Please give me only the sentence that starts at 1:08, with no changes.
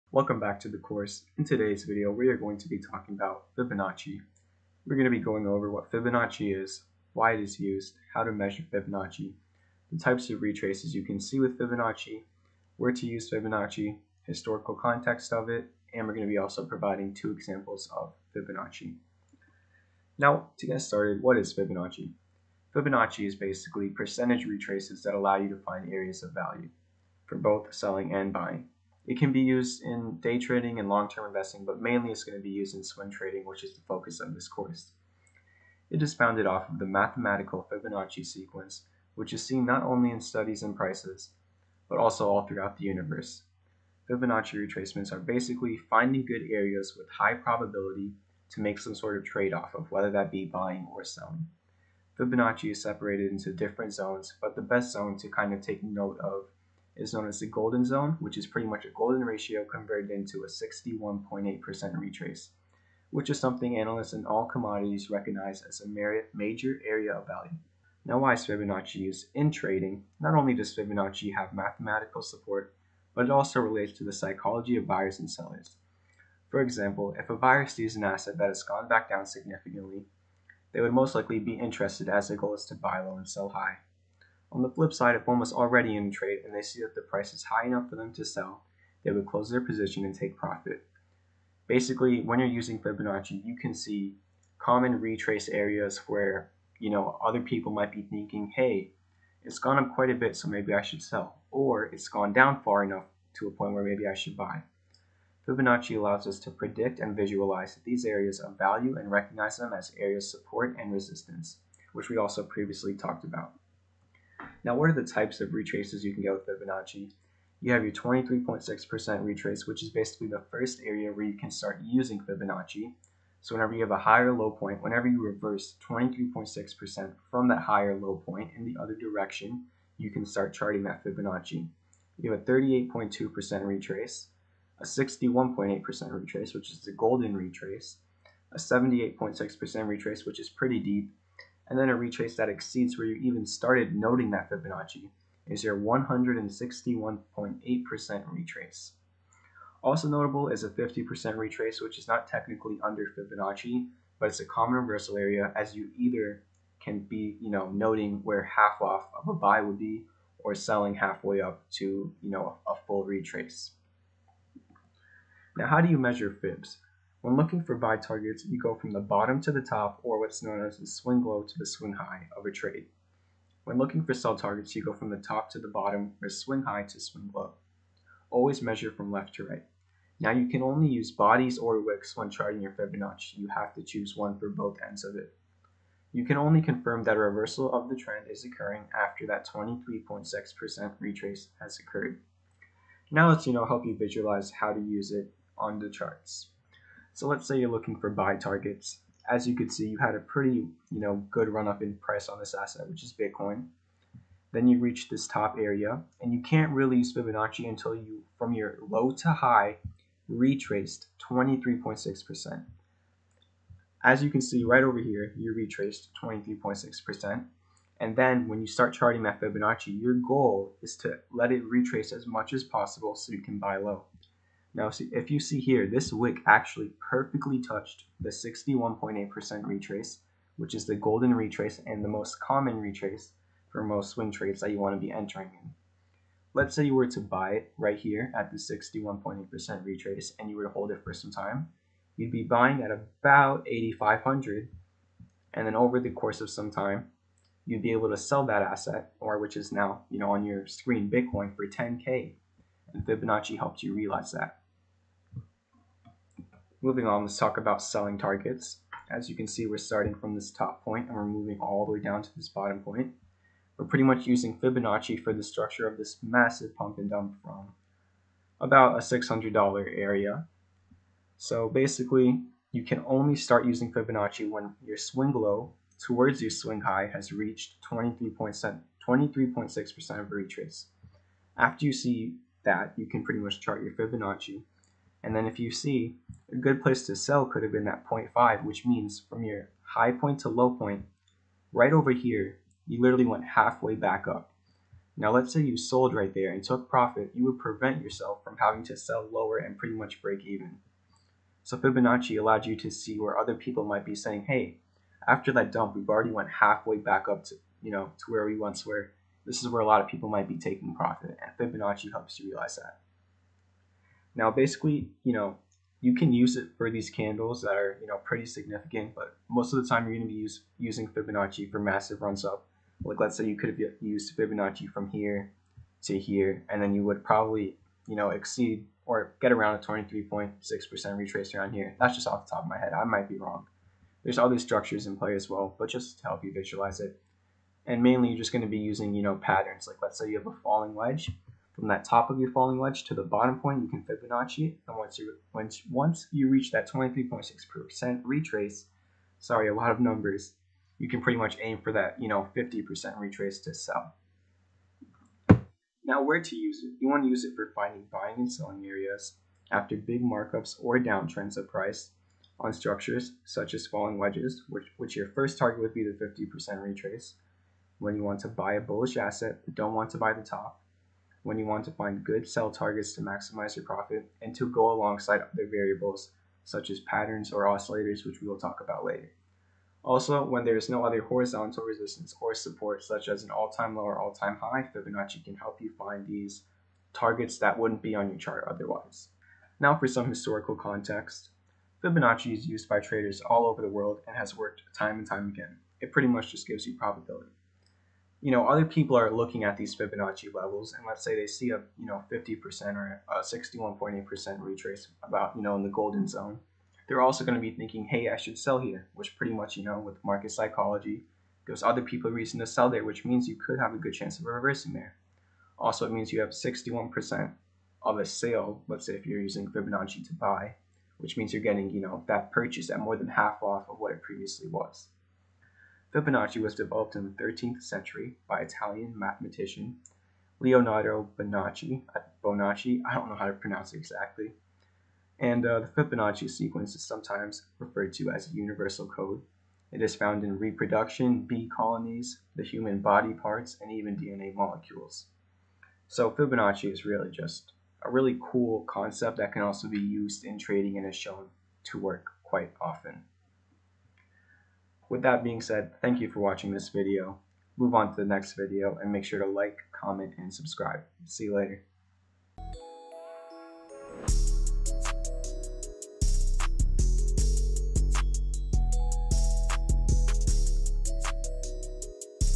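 Now, why is Fibonacci used in trading?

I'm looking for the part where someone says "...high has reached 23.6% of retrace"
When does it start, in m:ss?
4:36.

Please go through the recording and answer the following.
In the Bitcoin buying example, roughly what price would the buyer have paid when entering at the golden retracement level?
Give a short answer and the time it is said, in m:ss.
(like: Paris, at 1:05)
8,500, at 4:03.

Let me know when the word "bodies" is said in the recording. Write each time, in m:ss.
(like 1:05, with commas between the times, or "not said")
3:01.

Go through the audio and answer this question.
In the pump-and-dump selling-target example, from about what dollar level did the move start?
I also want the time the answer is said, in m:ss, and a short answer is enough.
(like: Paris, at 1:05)
$600, at 4:28.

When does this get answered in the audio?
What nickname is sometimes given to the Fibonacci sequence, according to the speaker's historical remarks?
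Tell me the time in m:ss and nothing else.
7:18.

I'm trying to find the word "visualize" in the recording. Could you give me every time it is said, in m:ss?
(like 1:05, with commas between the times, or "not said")
1:47, 3:13, 5:36.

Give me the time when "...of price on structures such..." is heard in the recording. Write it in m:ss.
6:01.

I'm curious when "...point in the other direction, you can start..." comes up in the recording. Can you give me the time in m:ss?
2:08.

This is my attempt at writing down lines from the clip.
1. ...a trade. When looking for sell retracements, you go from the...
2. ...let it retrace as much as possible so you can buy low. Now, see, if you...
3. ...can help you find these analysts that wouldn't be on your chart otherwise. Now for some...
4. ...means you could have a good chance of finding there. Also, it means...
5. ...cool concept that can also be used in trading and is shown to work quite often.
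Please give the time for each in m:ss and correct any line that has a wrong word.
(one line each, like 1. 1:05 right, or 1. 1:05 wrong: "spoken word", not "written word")
1. 2:52 wrong: "targets", not "retracements"
2. 3:41 right
3. 6:25 wrong: "targets", not "analysts"
4. 6:53 wrong: "reversing", not "finding"
5. 7:28 right.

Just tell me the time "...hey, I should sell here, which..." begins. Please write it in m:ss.
6:48.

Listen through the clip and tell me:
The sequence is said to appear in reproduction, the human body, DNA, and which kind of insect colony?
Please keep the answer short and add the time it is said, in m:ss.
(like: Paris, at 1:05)
bee colonies, at 7:21.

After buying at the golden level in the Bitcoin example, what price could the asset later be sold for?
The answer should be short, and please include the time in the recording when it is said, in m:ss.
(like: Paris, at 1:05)
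10K, at 4:11.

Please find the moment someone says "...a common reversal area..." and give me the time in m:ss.
2:34.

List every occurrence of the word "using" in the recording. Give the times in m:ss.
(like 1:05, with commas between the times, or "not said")
1:32, 2:01, 4:24, 4:33, 5:20, 5:38, 6:59.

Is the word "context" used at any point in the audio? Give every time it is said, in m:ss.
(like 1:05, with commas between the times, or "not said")
0:14, 6:30.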